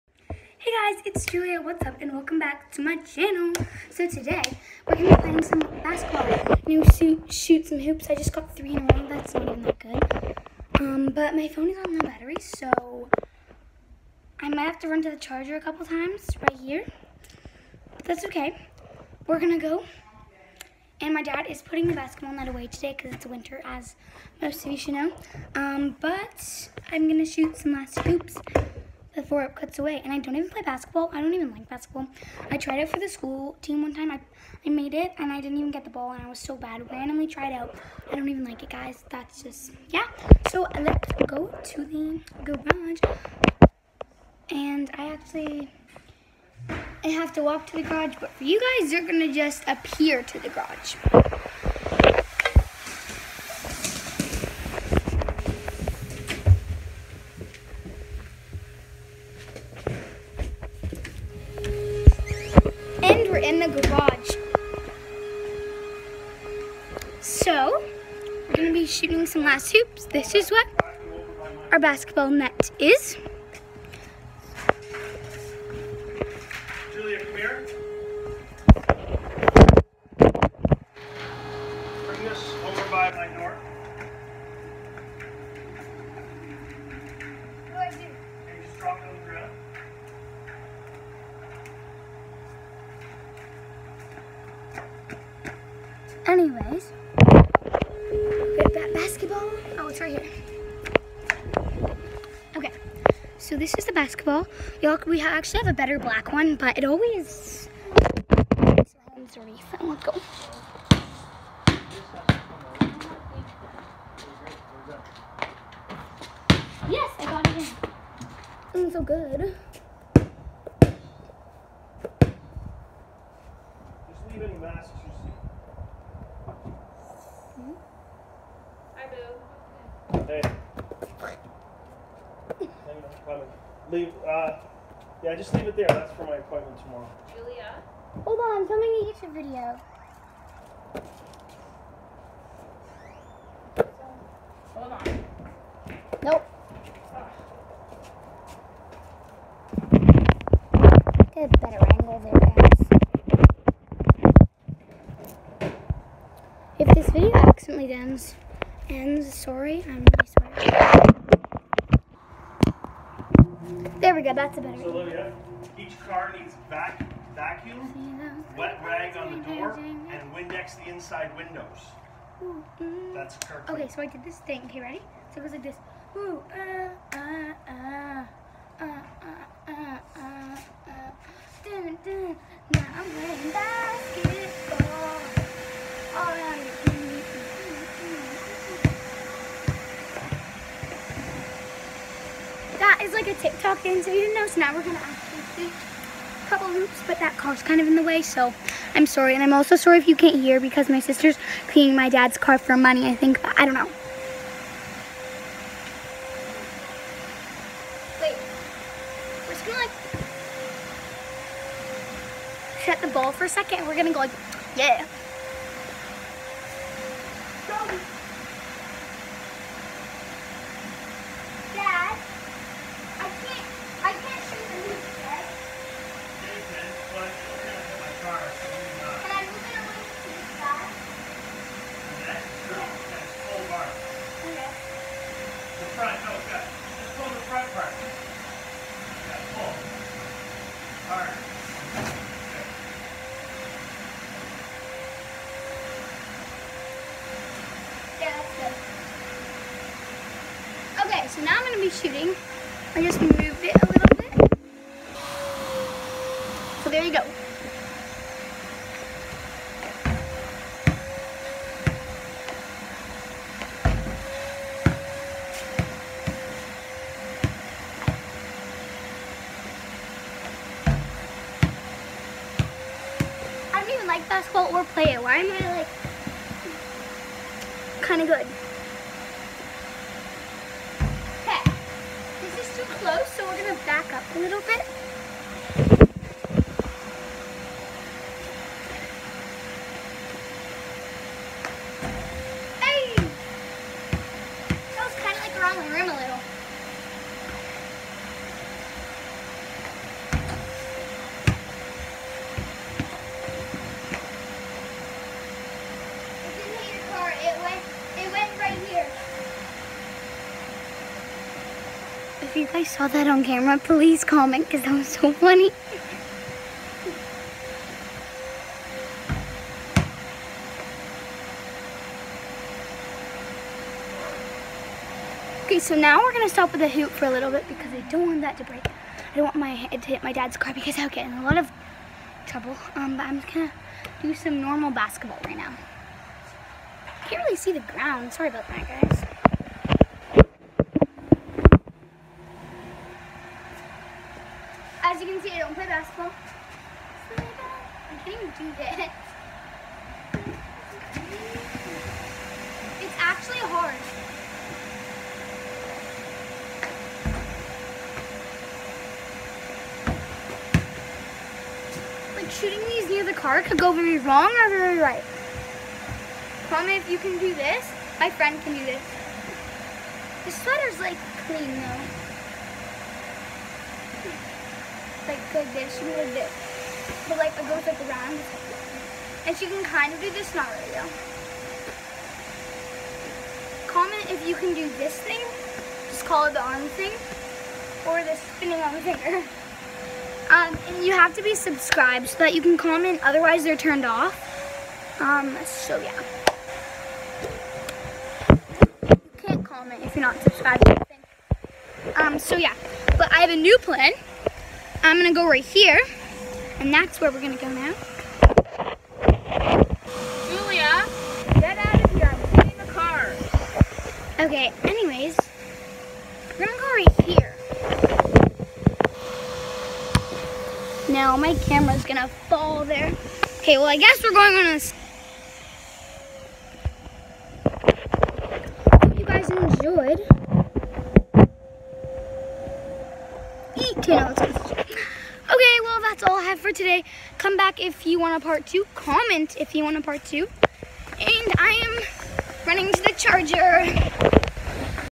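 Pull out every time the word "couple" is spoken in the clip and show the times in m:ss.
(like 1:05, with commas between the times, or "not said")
0:15, 3:16.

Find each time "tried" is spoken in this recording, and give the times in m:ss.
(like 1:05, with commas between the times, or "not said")
0:32, 0:37.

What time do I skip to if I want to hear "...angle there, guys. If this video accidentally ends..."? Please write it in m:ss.
2:31.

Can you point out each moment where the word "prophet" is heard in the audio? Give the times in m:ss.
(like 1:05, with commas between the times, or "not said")
not said.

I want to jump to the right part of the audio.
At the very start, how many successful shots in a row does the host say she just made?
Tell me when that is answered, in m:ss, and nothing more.
0:08.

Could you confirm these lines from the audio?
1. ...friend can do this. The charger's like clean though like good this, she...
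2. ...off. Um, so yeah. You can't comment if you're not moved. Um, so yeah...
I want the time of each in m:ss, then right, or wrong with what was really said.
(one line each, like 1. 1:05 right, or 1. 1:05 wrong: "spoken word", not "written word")
1. 6:08 wrong: "sweater", not "charger"
2. 6:34 wrong: "subscribed", not "moved".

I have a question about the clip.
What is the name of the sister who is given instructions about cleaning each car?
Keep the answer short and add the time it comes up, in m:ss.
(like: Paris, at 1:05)
Olivia, at 2:44.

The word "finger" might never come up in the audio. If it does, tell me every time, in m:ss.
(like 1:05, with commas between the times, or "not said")
6:29.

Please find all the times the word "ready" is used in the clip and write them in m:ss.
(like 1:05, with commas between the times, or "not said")
2:54.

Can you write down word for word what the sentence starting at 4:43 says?
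close, so we're gonna back up a little bit.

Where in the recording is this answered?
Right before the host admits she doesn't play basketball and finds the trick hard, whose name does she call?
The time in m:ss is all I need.
5:45.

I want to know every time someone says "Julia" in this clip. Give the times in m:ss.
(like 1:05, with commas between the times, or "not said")
0:01, 2:17, 6:50.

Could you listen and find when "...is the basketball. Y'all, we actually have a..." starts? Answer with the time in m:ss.
1:43.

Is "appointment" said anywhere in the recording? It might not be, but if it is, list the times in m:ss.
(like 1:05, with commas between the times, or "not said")
2:16.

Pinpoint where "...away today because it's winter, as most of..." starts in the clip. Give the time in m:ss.
0:22.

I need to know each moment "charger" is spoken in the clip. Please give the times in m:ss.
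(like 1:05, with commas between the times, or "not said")
0:15, 7:23.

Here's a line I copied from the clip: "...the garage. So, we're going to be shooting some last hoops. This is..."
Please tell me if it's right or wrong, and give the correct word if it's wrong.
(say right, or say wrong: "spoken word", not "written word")
right.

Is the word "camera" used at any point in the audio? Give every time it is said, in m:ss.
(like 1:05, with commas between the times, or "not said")
5:13, 7:01.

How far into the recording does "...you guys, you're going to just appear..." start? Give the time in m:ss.
0:48.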